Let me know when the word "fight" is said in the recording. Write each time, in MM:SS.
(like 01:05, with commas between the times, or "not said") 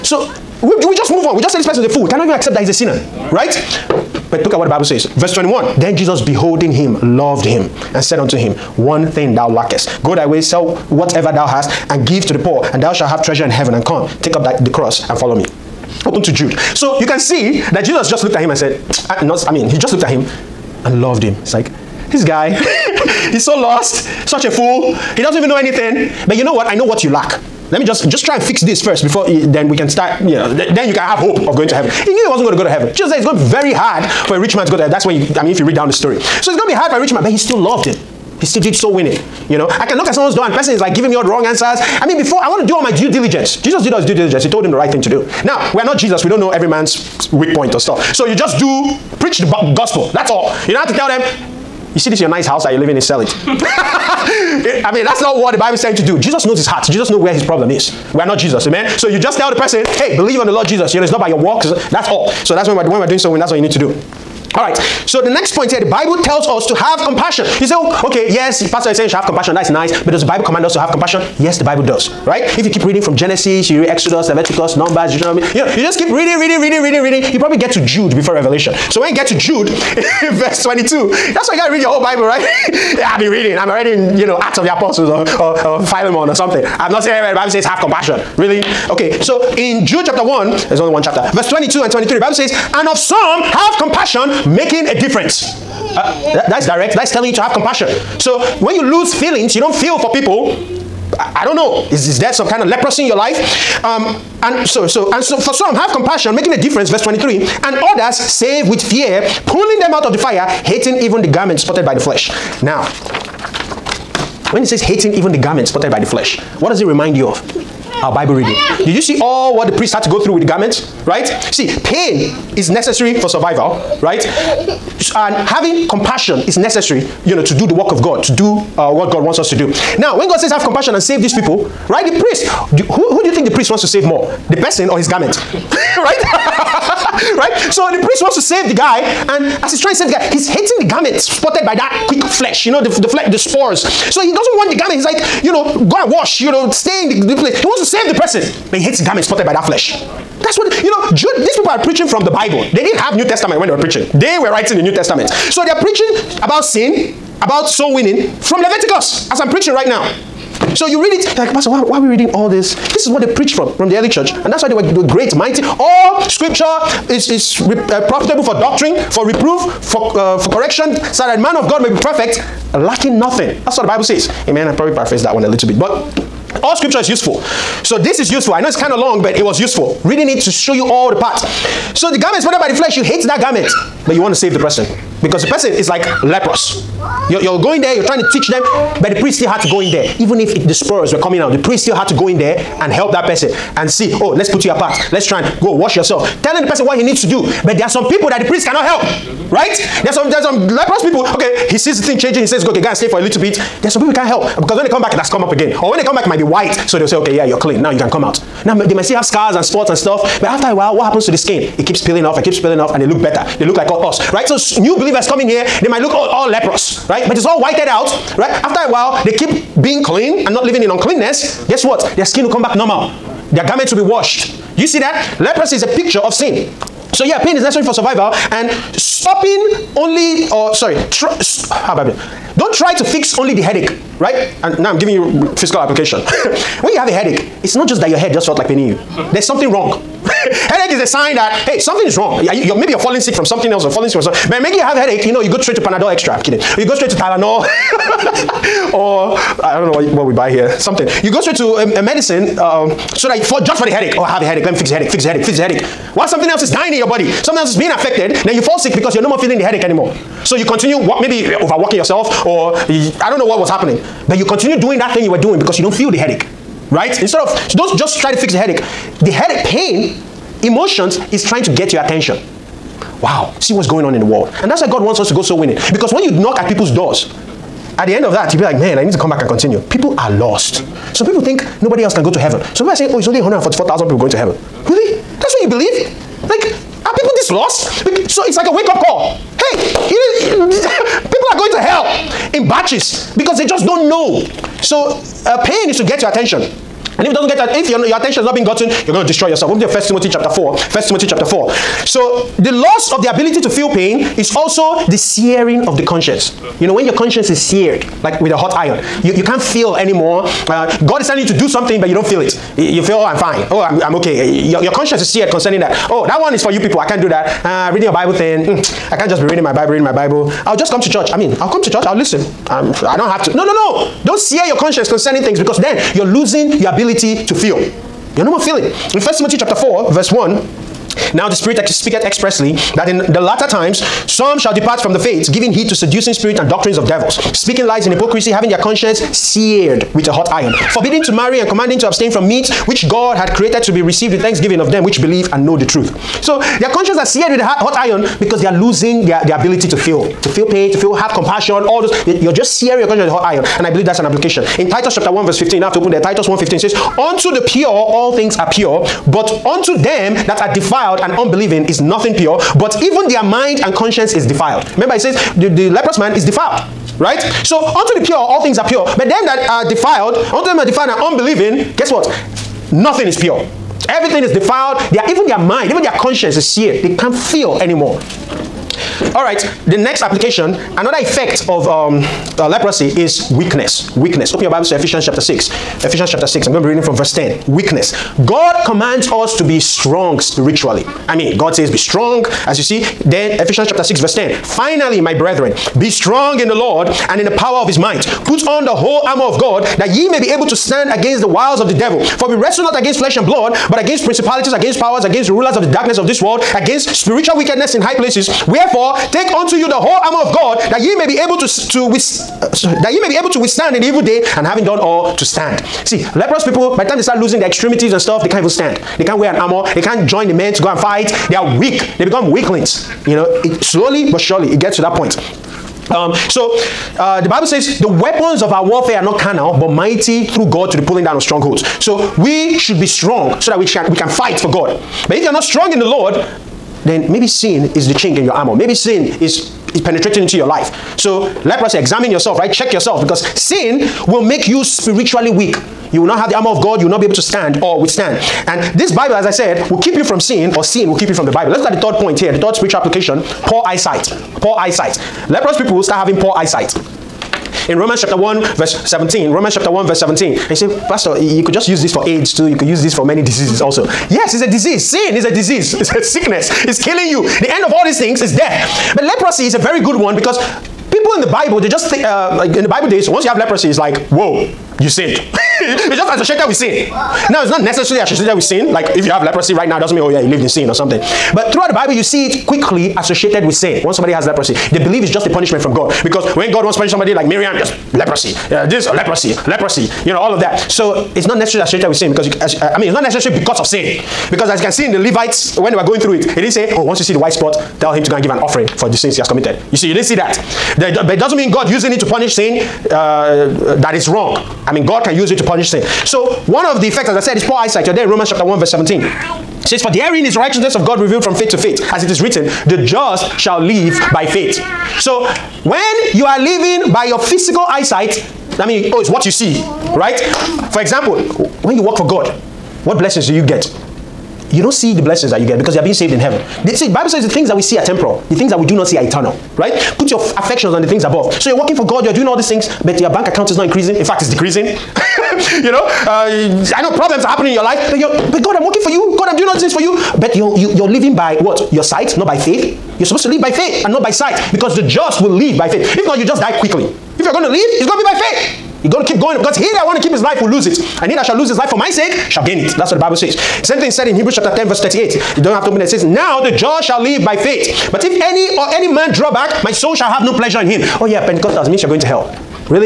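07:00, 07:14.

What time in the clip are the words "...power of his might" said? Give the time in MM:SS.
06:37.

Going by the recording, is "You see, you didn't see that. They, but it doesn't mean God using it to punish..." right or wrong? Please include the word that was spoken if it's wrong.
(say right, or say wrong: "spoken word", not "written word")
right.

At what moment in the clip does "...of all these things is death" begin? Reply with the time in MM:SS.
07:47.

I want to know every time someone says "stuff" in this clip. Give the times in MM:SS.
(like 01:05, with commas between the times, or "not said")
00:47, 03:29, 06:58.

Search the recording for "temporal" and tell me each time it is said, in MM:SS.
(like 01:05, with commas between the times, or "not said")
08:48.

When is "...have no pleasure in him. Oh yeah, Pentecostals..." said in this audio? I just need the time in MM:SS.
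09:20.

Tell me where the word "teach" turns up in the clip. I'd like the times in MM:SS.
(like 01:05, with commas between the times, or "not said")
03:08.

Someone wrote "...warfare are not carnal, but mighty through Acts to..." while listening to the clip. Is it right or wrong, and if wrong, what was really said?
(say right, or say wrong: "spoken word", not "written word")
wrong: "God", not "Acts".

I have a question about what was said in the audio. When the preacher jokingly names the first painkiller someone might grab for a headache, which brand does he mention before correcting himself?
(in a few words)
Panadol Extra.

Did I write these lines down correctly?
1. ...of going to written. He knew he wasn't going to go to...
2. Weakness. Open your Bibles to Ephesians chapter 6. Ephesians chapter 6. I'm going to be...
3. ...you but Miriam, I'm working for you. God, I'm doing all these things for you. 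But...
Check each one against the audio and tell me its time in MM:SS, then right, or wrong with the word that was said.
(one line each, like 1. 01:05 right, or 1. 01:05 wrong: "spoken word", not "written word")
1. 00:31 wrong: "heaven", not "written"
2. 06:24 right
3. 08:58 wrong: "God", not "Miriam".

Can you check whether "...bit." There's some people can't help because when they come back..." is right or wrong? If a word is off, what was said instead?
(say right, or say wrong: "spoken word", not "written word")
right.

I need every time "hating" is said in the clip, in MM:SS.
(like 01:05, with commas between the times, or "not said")
01:50, 01:54, 02:20.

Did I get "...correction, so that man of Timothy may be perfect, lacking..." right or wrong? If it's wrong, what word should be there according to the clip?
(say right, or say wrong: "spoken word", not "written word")
wrong: "God", not "Timothy".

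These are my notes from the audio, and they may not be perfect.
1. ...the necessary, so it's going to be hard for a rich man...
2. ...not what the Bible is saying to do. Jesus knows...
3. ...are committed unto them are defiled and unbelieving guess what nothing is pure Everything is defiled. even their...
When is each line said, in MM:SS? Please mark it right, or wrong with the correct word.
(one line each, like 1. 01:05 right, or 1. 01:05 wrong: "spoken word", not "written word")
1. 00:35 wrong: "story", not "necessary"
2. 00:55 right
3. 06:09 wrong: "defiled", not "committed".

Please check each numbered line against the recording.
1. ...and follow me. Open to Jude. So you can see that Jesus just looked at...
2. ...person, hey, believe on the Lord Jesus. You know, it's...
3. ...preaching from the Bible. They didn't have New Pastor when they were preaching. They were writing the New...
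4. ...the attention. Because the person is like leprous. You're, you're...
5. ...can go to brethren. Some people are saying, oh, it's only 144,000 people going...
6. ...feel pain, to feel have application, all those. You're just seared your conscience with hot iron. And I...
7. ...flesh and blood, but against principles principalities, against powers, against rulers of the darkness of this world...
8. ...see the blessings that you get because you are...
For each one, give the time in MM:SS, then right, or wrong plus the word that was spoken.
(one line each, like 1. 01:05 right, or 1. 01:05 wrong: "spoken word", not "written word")
1. 00:15 right
2. 00:59 right
3. 02:31 wrong: "Testament", not "Pastor"
4. 03:04 wrong: "person", not "attention"
5. 04:42 wrong: "heaven", not "brethren"
6. 05:50 wrong: "compassion", not "application"
7. 06:43 right
8. 08:44 right.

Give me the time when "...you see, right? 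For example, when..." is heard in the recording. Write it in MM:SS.
08:39.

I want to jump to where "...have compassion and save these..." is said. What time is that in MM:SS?
02:10.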